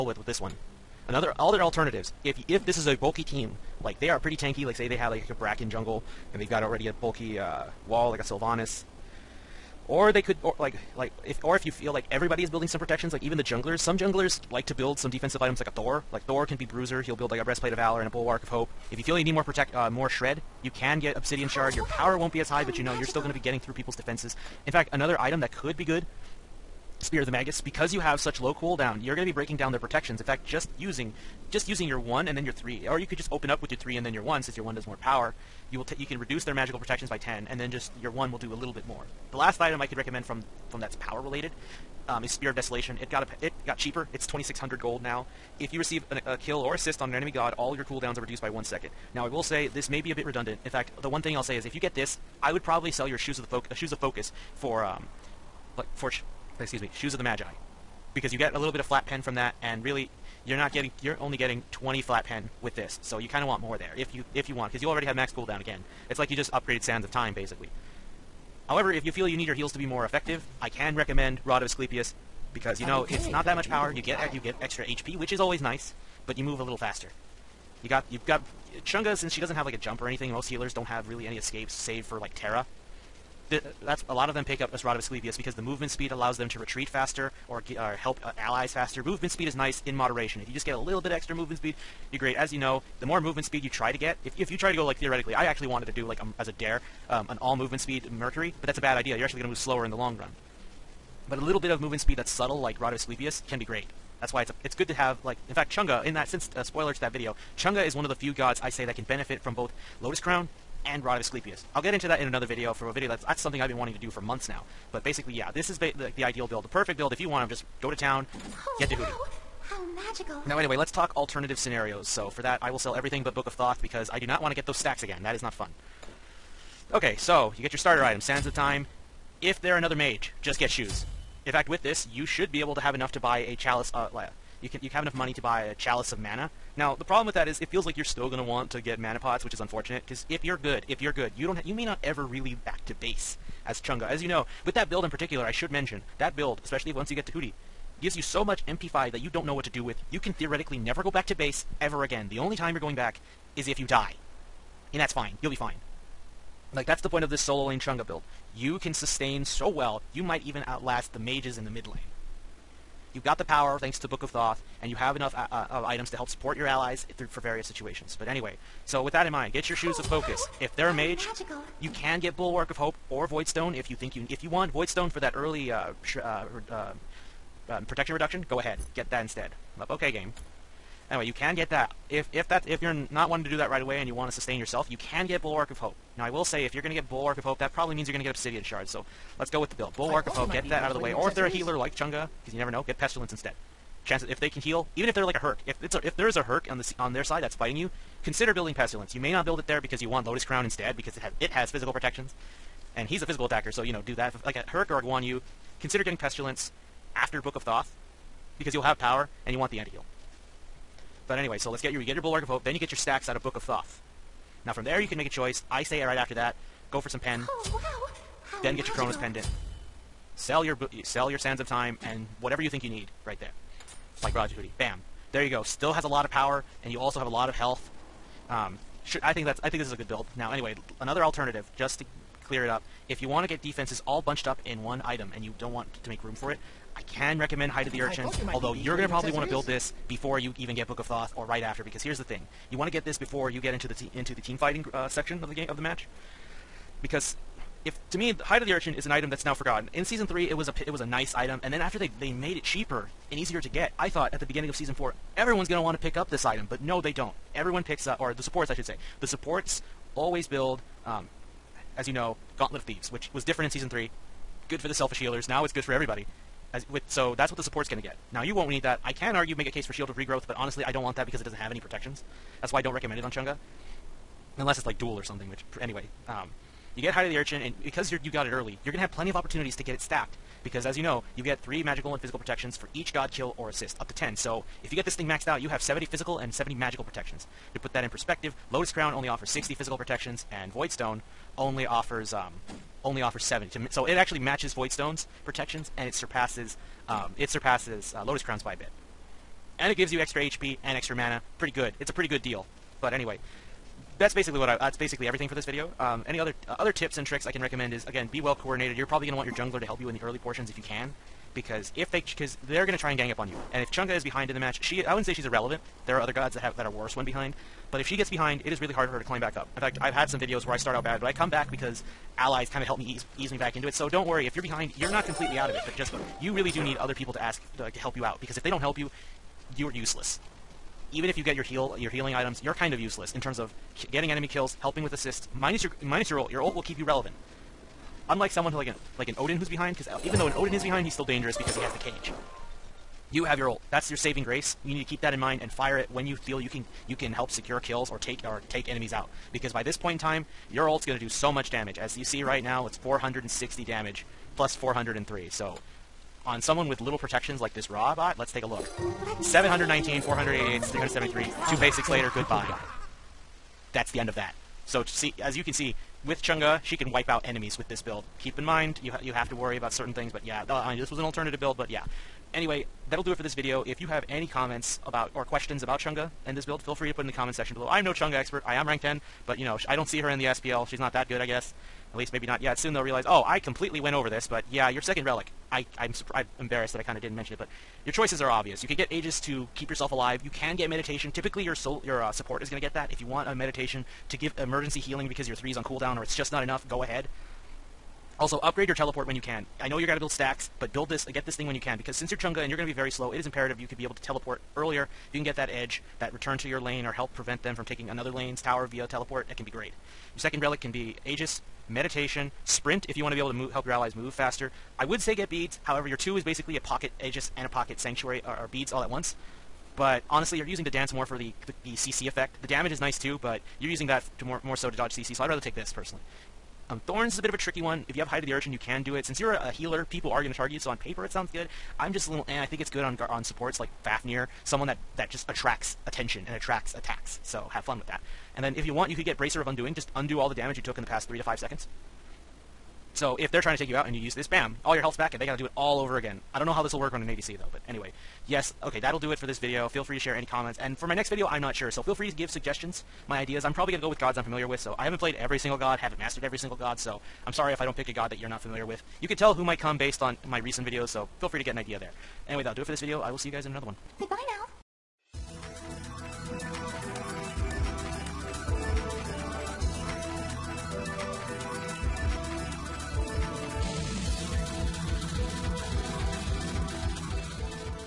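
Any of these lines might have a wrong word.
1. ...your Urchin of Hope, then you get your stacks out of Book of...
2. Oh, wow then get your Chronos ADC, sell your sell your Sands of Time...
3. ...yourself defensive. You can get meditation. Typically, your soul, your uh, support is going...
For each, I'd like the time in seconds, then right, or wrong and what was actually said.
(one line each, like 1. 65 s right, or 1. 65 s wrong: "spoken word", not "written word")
1. 212 s wrong: "Bulwark", not "Urchin"
2. 217 s wrong: "Pendant", not "ADC"
3. 389 s wrong: "alive", not "defensive".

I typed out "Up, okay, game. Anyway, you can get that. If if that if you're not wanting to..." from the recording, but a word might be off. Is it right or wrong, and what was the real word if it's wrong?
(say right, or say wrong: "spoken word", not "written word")
right.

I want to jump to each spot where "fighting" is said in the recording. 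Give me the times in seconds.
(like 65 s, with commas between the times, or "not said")
197 s, 244 s.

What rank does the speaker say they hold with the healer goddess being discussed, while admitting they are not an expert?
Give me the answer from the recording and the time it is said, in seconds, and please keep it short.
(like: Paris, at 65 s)
Rank 10, at 378 s.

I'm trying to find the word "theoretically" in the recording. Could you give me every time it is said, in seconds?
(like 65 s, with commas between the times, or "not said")
94 s, 150 s.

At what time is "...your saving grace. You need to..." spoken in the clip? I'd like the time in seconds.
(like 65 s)
344 s.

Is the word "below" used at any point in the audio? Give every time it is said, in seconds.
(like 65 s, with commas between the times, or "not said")
377 s.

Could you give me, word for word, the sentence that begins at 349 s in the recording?
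Because by this point in time, your ult's going to do so much damage.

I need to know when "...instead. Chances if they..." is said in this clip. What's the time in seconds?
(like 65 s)
193 s.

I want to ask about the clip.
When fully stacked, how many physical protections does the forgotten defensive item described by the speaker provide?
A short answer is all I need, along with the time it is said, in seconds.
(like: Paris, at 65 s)
70, at 285 s.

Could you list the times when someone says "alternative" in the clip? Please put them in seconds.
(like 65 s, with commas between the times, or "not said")
1 s, 121 s, 231 s, 371 s.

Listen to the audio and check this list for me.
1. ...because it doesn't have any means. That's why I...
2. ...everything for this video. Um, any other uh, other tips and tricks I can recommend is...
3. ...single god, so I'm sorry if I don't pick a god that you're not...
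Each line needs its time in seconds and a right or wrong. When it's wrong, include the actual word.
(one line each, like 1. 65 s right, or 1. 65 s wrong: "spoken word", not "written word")
1. 271 s wrong: "protections", not "means"
2. 305 s right
3. 456 s right.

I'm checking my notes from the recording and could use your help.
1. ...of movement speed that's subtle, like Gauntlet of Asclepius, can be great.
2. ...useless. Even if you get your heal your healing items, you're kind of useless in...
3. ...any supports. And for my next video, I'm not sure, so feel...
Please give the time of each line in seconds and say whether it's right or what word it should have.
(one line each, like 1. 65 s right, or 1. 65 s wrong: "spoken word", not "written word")
1. 101 s wrong: "Rod", not "Gauntlet"
2. 329 s right
3. 450 s wrong: "comments", not "supports".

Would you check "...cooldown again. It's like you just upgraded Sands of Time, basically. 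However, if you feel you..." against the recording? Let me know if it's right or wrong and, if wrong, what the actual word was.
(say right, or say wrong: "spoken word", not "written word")
right.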